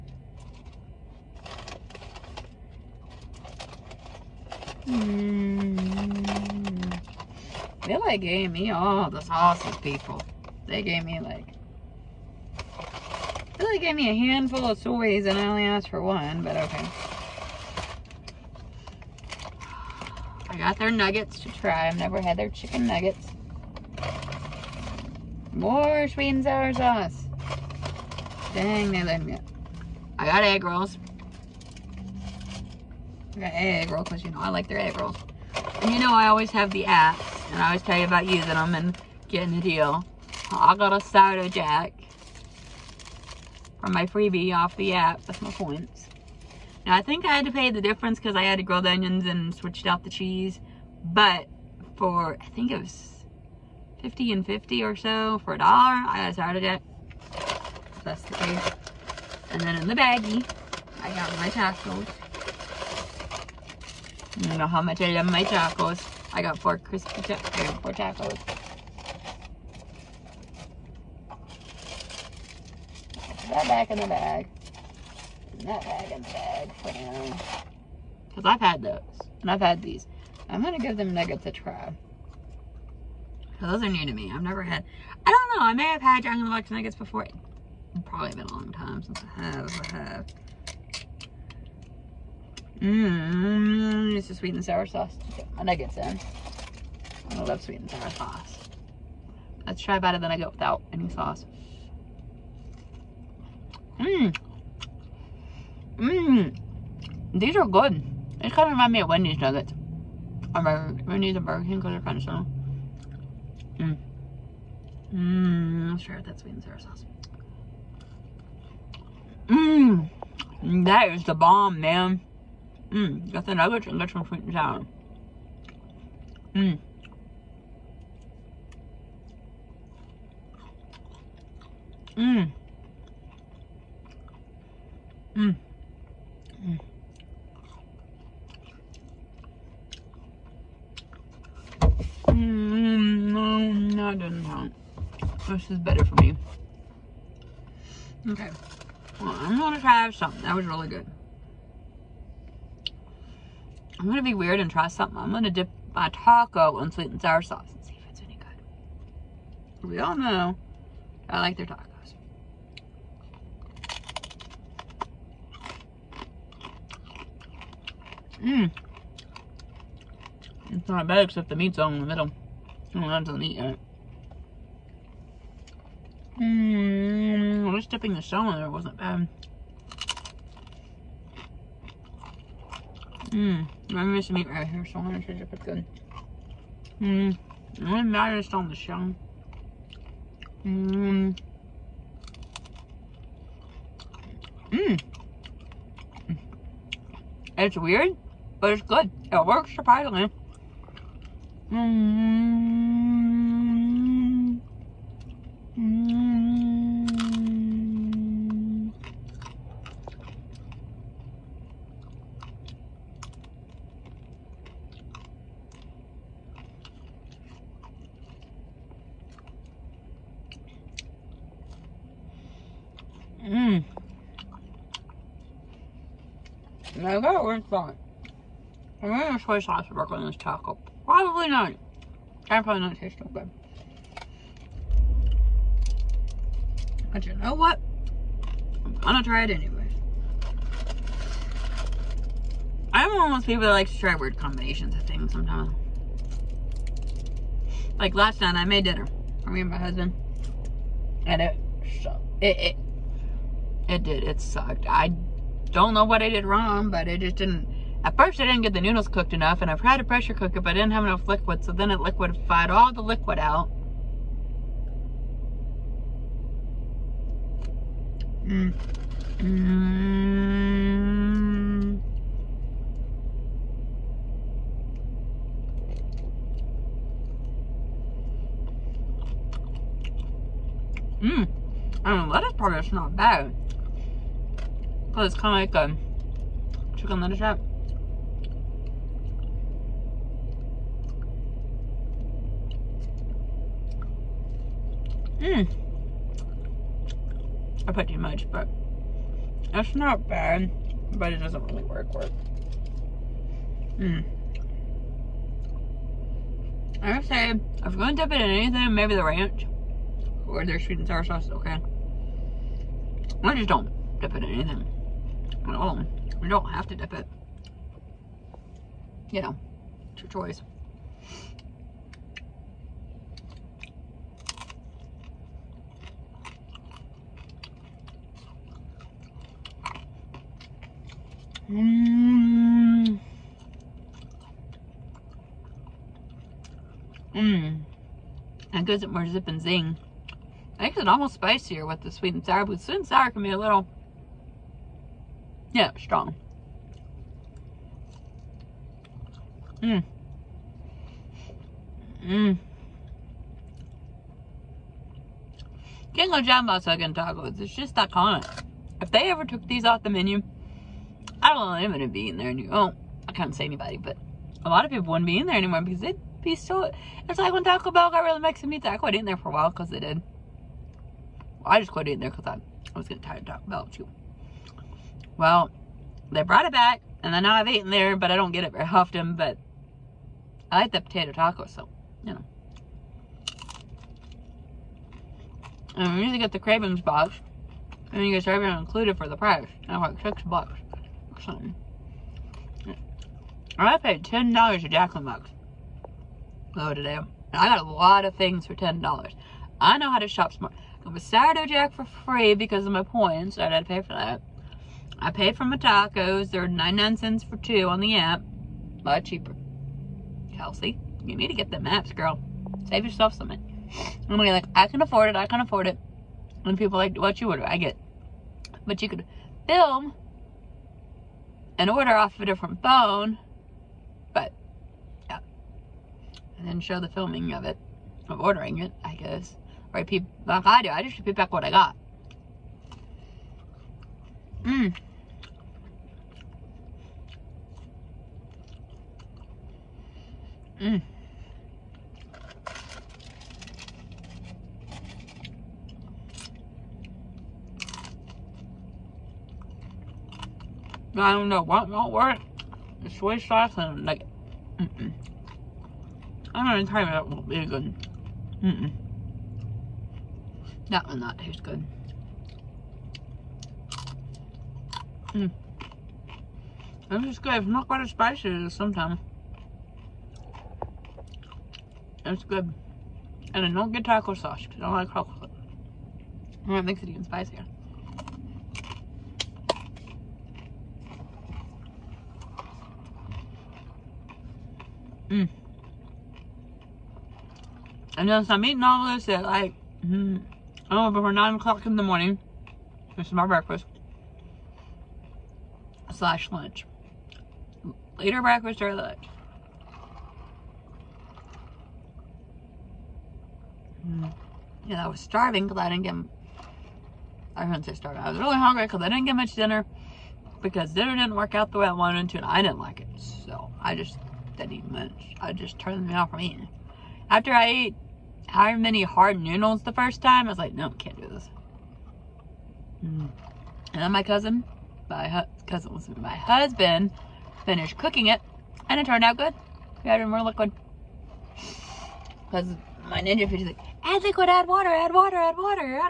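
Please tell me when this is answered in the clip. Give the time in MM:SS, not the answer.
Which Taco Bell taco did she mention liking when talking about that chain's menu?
06:20.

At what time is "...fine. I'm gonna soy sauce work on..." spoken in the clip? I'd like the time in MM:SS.
03:47.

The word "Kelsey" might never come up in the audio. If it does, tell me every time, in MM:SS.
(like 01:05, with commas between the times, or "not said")
06:50.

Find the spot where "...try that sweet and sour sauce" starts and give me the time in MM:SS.
01:56.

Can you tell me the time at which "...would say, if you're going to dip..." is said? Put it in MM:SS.
05:07.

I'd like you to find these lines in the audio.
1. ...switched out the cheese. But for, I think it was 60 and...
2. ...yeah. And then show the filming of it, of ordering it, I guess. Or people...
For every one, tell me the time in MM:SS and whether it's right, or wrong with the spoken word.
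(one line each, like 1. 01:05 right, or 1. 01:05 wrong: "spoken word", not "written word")
1. 00:49 wrong: "50", not "60"
2. 07:05 right.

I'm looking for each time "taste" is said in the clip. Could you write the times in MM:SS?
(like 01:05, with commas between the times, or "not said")
03:52, 07:41.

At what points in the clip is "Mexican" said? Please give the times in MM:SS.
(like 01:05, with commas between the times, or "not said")
06:08.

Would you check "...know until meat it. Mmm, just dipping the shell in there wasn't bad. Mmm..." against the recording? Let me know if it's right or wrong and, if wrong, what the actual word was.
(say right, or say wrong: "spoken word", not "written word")
right.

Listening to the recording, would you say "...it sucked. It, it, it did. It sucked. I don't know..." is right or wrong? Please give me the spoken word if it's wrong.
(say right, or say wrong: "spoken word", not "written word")
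right.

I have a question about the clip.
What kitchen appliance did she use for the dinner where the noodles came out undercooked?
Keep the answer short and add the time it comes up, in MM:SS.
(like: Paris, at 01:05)
pressure cooker, at 04:20.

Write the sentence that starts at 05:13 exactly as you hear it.
I just don't dip it in anything at all.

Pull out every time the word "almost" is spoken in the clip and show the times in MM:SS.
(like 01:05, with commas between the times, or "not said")
05:41.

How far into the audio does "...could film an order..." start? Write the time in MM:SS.
06:59.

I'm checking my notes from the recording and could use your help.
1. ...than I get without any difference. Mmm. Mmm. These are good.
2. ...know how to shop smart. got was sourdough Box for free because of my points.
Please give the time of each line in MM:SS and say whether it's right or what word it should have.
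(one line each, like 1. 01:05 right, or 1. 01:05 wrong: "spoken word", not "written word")
1. 01:40 wrong: "sauce", not "difference"
2. 06:39 wrong: "Jack", not "Box".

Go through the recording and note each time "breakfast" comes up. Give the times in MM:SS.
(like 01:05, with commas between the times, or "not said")
08:13, 08:18.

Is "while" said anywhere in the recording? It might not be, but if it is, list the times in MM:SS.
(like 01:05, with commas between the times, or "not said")
06:09.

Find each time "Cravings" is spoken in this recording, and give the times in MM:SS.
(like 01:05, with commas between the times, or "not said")
06:26.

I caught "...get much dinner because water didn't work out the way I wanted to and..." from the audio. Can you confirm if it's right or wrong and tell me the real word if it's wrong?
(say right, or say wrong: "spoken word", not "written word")
wrong: "dinner", not "water".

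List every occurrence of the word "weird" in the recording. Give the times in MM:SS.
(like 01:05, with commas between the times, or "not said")
02:34, 03:17, 04:04.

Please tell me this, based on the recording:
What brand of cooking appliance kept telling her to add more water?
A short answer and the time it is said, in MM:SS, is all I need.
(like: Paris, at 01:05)
Ninja Foodi, at 08:53.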